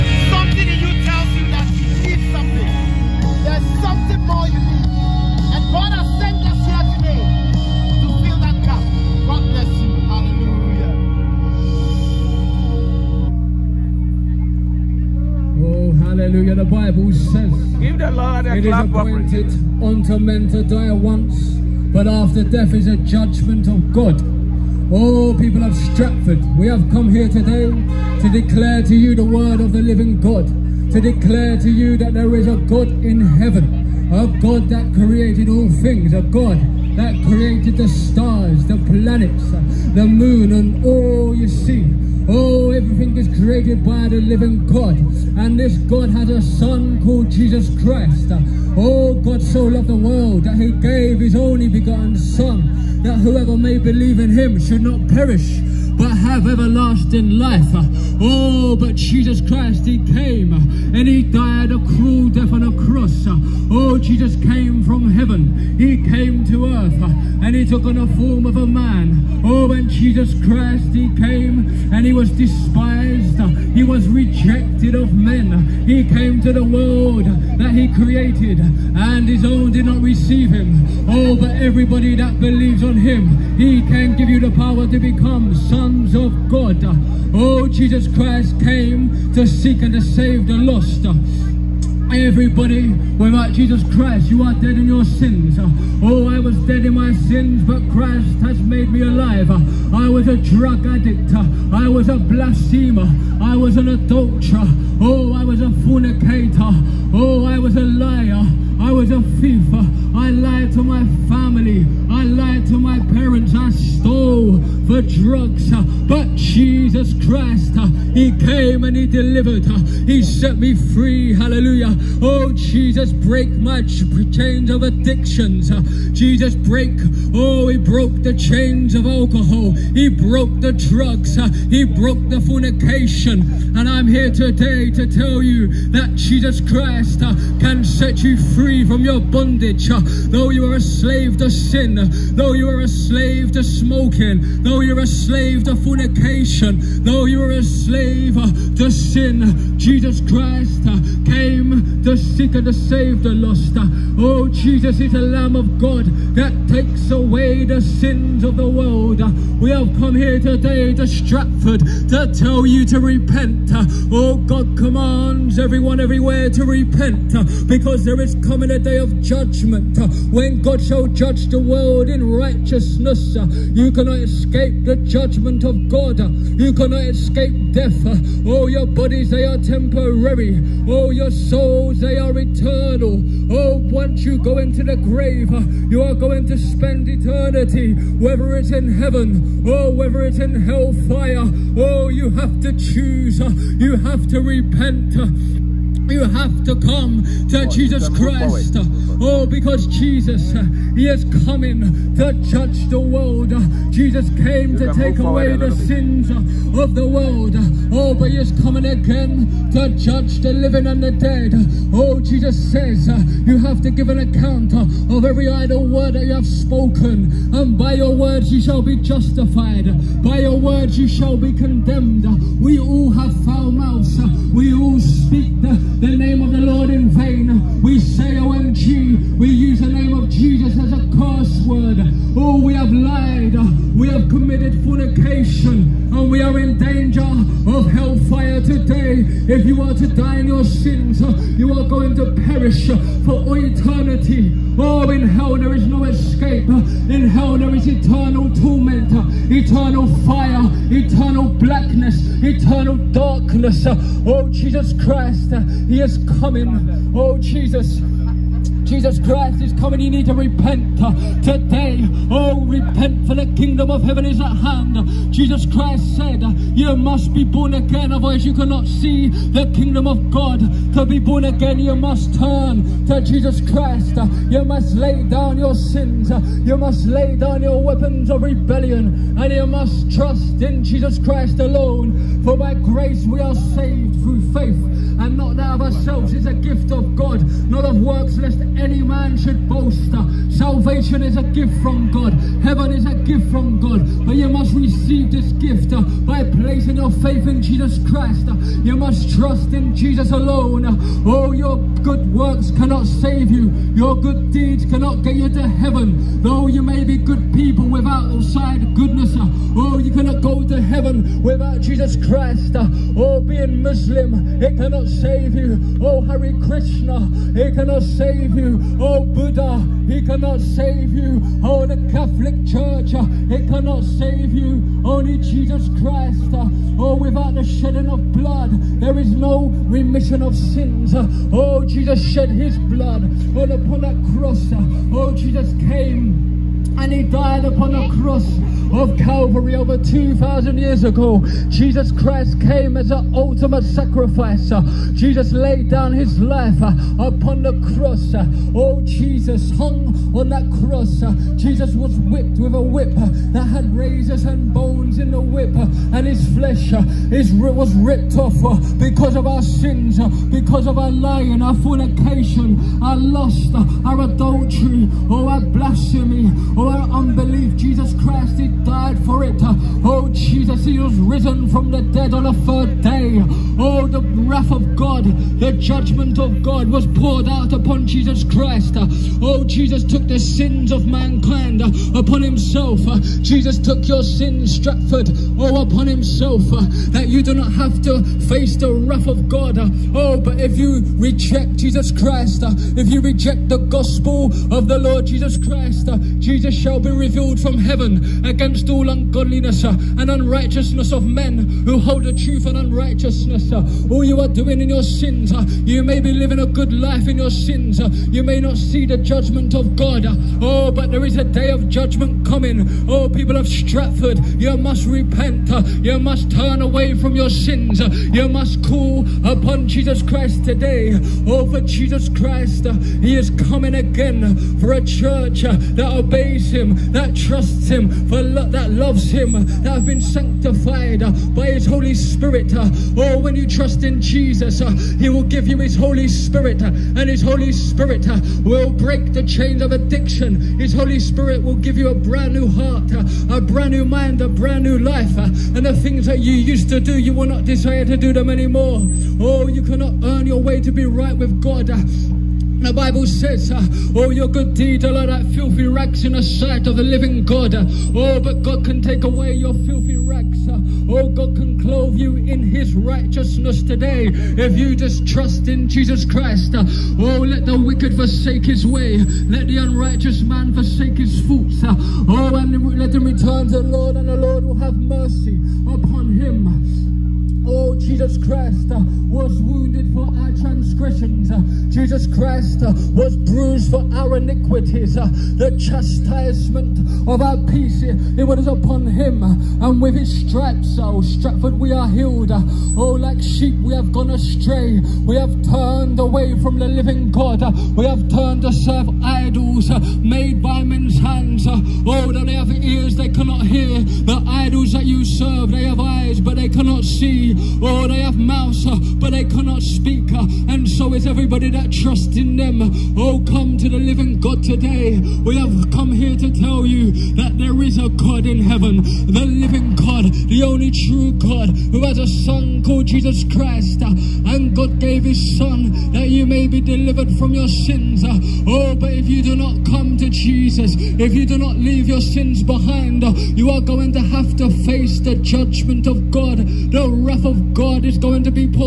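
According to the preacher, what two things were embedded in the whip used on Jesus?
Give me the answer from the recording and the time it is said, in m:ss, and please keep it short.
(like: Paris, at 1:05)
razors and bones, at 5:53.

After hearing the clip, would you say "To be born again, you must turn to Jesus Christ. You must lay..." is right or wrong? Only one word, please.
right.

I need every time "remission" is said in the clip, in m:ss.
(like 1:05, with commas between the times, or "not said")
5:29.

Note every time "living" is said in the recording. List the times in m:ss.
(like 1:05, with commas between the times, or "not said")
0:29, 0:44, 3:30, 6:46, 7:37, 8:16, 8:33, 8:39.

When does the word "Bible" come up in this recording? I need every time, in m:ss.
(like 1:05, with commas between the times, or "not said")
0:16, 7:32.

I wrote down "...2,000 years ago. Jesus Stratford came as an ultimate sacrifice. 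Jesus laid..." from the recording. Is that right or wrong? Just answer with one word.
wrong.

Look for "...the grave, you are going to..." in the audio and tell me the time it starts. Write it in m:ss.
3:04.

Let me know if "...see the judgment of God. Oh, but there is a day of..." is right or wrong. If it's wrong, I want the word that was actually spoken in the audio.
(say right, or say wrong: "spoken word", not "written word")
right.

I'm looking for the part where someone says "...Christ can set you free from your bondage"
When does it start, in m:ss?
2:16.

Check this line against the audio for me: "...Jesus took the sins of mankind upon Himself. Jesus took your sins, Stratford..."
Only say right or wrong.
right.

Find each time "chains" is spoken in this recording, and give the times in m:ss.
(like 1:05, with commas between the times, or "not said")
2:03, 2:08, 7:19.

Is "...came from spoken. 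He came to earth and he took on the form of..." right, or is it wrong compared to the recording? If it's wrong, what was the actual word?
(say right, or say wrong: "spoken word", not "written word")
wrong: "heaven", not "spoken".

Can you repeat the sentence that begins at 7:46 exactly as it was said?
Uh, oh, let the wicked forsake his way.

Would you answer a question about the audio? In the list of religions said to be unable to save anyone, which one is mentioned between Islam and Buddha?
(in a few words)
Hare Krishna.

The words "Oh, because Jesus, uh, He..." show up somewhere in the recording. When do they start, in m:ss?
3:19.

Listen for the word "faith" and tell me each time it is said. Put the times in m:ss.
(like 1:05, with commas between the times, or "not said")
4:44, 4:57.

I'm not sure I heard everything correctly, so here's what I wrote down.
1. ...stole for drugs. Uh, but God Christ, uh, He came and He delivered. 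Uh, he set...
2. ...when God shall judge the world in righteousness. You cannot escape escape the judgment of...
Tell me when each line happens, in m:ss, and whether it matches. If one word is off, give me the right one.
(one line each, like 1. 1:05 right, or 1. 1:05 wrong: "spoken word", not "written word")
1. 1:53 wrong: "Jesus", not "God"
2. 2:50 right.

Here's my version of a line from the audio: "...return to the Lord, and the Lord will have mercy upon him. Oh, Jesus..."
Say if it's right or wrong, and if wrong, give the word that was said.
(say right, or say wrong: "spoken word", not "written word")
right.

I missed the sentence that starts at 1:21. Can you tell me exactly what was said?
Oh, but everybody that believes on him, he can give you the power to become sons of God.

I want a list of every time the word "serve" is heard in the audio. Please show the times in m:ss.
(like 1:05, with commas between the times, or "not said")
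8:18, 8:25.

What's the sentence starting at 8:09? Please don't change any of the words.
Uh, and with his stripes, oh, Stratford, we are healed.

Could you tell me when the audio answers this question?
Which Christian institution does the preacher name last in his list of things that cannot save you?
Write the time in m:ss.
5:21.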